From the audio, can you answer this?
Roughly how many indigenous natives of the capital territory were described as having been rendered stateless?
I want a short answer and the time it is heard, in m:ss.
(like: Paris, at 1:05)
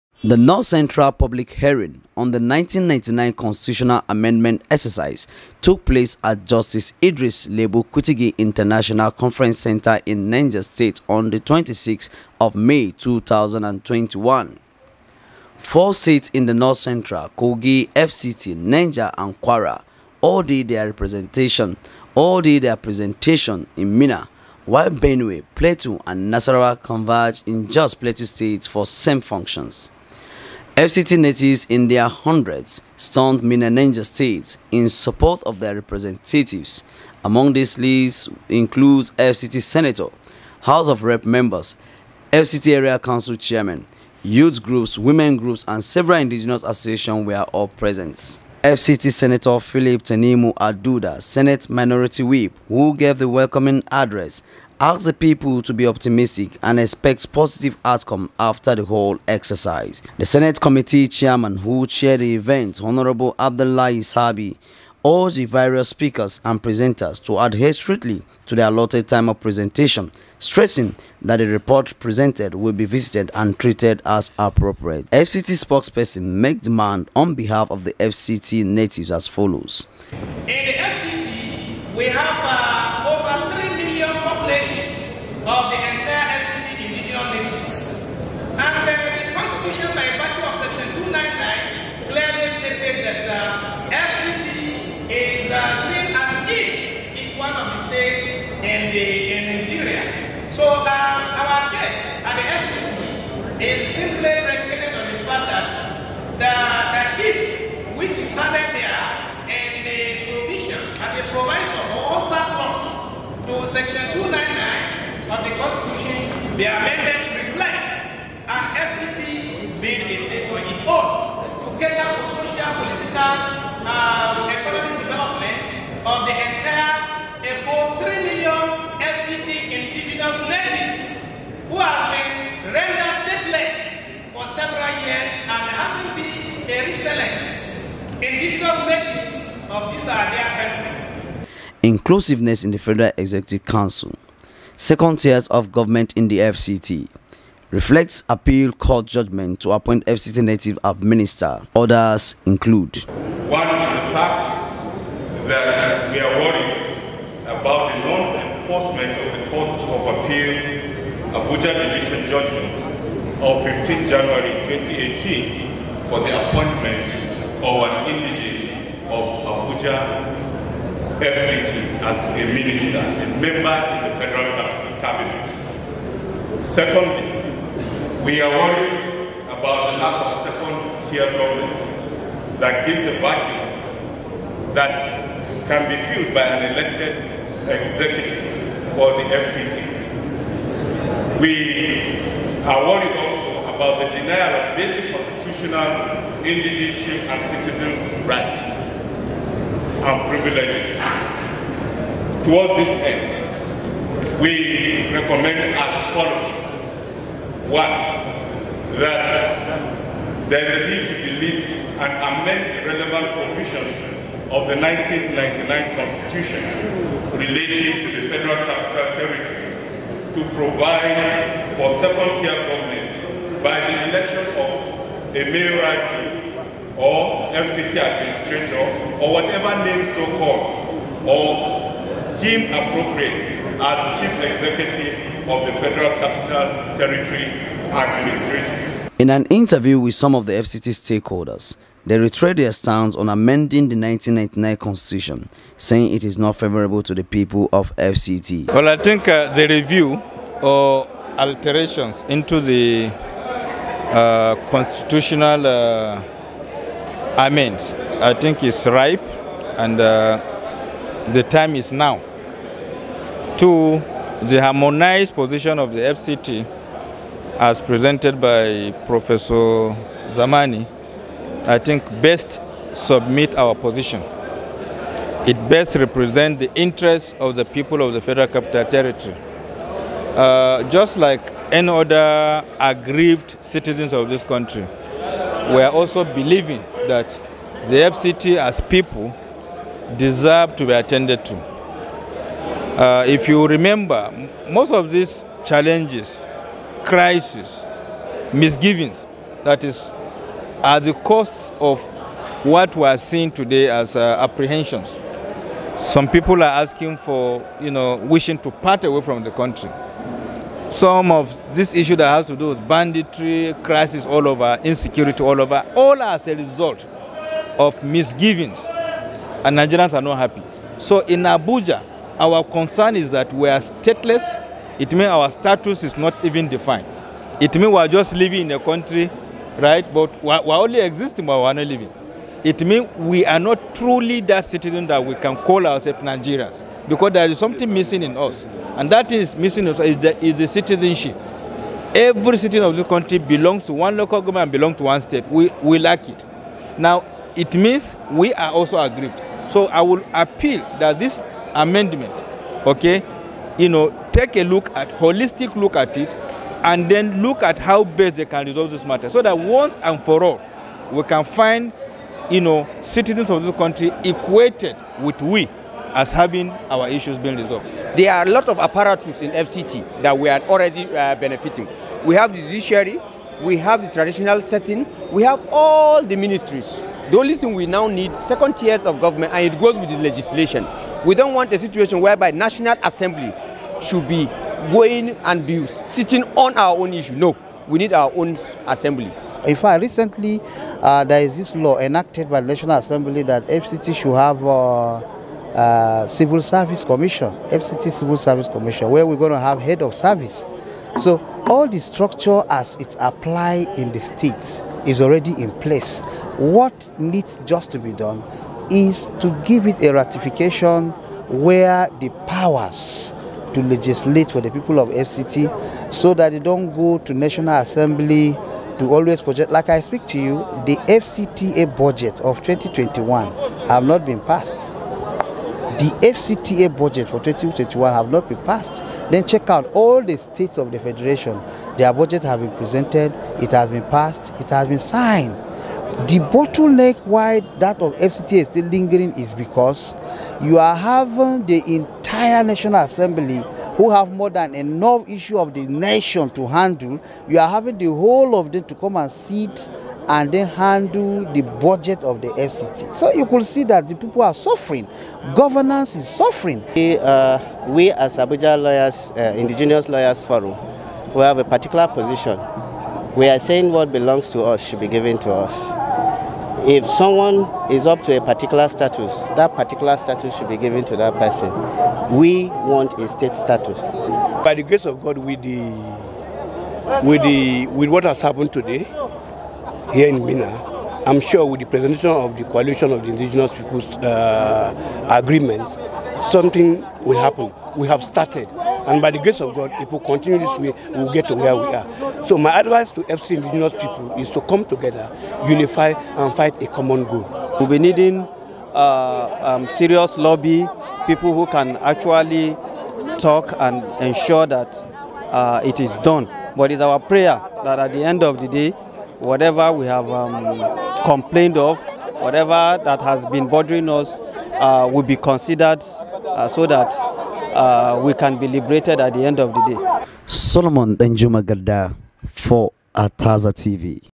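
3 million, at 2:08.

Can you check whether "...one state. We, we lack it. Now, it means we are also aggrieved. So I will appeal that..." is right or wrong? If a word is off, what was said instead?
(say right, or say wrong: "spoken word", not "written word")
right.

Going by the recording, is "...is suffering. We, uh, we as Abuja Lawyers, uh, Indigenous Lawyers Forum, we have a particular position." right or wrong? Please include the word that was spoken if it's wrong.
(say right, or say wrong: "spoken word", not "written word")
right.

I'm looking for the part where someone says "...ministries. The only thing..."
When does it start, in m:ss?
6:16.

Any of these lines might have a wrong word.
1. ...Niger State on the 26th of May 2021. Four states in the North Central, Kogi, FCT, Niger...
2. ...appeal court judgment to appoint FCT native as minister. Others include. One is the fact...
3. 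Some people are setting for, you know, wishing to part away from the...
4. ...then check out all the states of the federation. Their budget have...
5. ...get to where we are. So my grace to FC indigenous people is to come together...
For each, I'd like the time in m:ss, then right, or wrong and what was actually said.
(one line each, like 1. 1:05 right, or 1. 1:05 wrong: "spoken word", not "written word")
1. 0:10 right
2. 2:28 right
3. 5:05 wrong: "asking", not "setting"
4. 7:09 right
5. 8:11 wrong: "advice", not "grace".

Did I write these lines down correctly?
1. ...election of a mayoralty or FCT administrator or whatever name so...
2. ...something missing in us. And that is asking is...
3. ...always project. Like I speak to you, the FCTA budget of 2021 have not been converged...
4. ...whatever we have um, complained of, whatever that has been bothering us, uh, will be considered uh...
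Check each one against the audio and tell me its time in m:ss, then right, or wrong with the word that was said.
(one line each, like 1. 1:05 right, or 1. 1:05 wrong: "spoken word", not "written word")
1. 3:44 right
2. 5:37 wrong: "missing", not "asking"
3. 6:59 wrong: "passed", not "converged"
4. 8:29 right.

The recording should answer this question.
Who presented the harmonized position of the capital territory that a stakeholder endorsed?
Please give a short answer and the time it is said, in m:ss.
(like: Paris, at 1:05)
Professor Zamani, at 4:29.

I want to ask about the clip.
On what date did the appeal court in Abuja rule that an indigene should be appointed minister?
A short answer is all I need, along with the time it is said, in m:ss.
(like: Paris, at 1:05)
15 January 2018, at 2:43.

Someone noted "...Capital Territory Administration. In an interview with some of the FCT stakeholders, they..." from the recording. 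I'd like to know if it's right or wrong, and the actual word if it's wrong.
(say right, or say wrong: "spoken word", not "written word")
right.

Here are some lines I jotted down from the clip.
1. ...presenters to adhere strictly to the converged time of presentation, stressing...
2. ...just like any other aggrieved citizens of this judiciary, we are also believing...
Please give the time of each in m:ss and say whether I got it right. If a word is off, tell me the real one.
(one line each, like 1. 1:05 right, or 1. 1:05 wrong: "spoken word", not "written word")
1. 1:06 wrong: "allotted", not "converged"
2. 4:40 wrong: "country", not "judiciary".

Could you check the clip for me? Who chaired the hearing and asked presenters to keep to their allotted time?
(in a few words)
Abdullahi Sabi.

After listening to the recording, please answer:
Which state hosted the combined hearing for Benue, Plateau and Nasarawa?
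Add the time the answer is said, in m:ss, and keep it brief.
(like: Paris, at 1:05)
Plateau State, at 0:27.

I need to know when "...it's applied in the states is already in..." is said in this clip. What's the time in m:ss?
6:42.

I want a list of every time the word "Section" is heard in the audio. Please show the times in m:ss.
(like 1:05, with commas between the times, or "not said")
1:30, 1:53.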